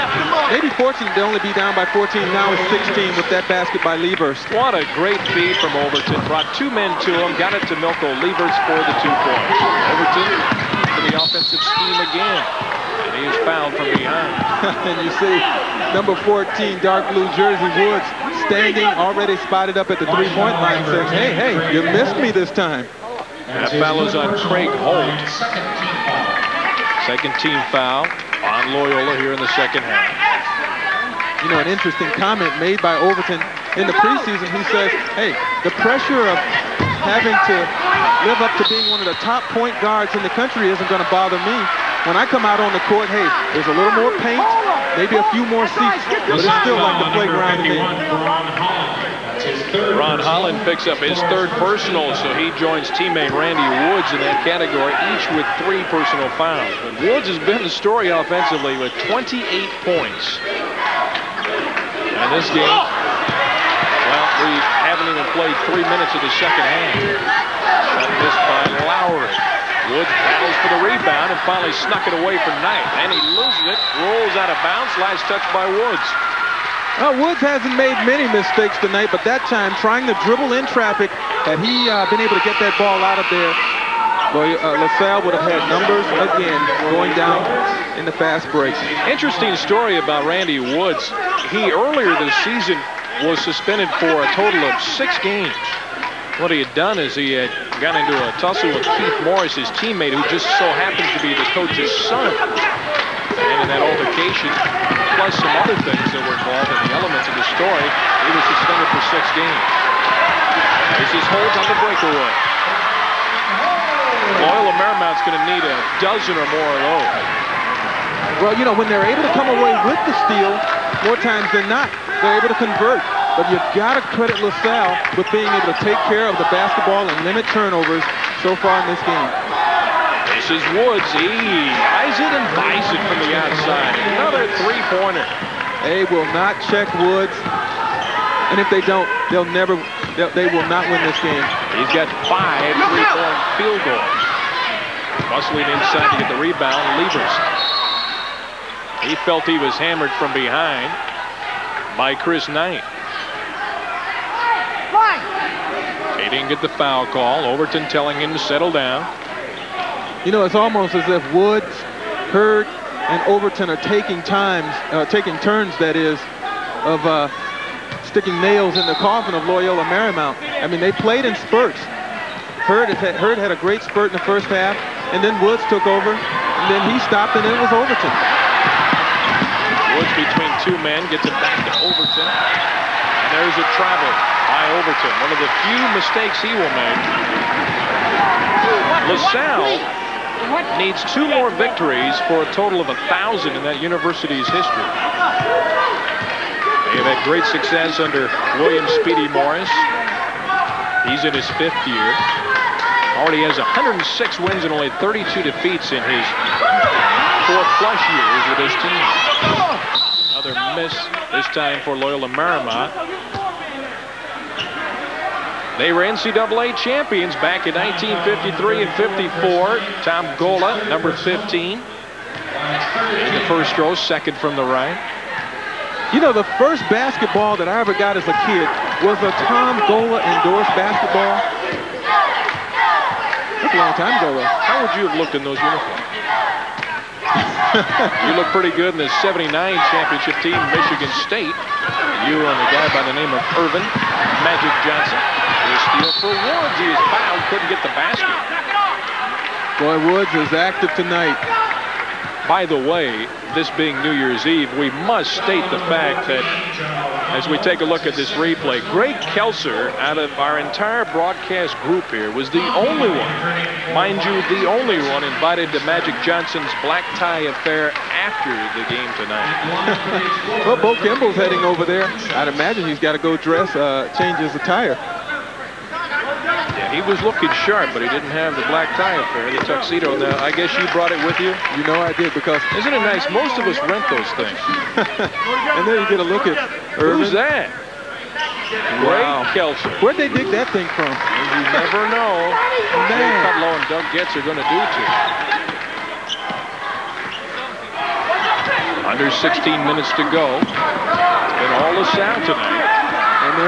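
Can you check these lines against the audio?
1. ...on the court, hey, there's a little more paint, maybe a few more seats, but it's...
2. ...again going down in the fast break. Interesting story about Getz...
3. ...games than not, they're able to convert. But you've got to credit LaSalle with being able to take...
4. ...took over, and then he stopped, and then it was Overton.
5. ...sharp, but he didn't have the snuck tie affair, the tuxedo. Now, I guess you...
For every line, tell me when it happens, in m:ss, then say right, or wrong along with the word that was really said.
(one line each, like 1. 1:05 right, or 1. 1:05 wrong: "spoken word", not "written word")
1. 0:42 right
2. 1:26 wrong: "Randy", not "Getz"
3. 2:01 wrong: "times", not "games"
4. 2:55 right
5. 4:37 wrong: "black", not "snuck".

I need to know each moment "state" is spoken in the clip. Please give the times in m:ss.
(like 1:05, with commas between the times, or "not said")
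4:01, 4:15.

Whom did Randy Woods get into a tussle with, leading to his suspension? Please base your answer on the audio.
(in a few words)
Keith Morris.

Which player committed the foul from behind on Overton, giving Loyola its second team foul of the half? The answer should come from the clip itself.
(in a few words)
Craig Holt.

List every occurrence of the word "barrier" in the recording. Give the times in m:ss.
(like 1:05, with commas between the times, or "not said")
not said.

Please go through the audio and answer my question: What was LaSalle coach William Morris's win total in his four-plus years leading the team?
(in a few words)
106.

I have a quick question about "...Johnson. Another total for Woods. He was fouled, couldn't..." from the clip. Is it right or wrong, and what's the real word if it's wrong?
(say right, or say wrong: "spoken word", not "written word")
wrong: "steal", not "total".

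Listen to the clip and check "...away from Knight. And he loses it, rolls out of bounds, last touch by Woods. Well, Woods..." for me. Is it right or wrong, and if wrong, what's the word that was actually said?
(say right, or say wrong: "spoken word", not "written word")
right.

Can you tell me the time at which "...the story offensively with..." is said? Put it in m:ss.
0:57.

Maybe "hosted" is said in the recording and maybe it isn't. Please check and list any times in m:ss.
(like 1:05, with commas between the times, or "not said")
not said.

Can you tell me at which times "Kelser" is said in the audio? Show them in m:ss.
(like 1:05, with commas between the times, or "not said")
4:19, 4:49.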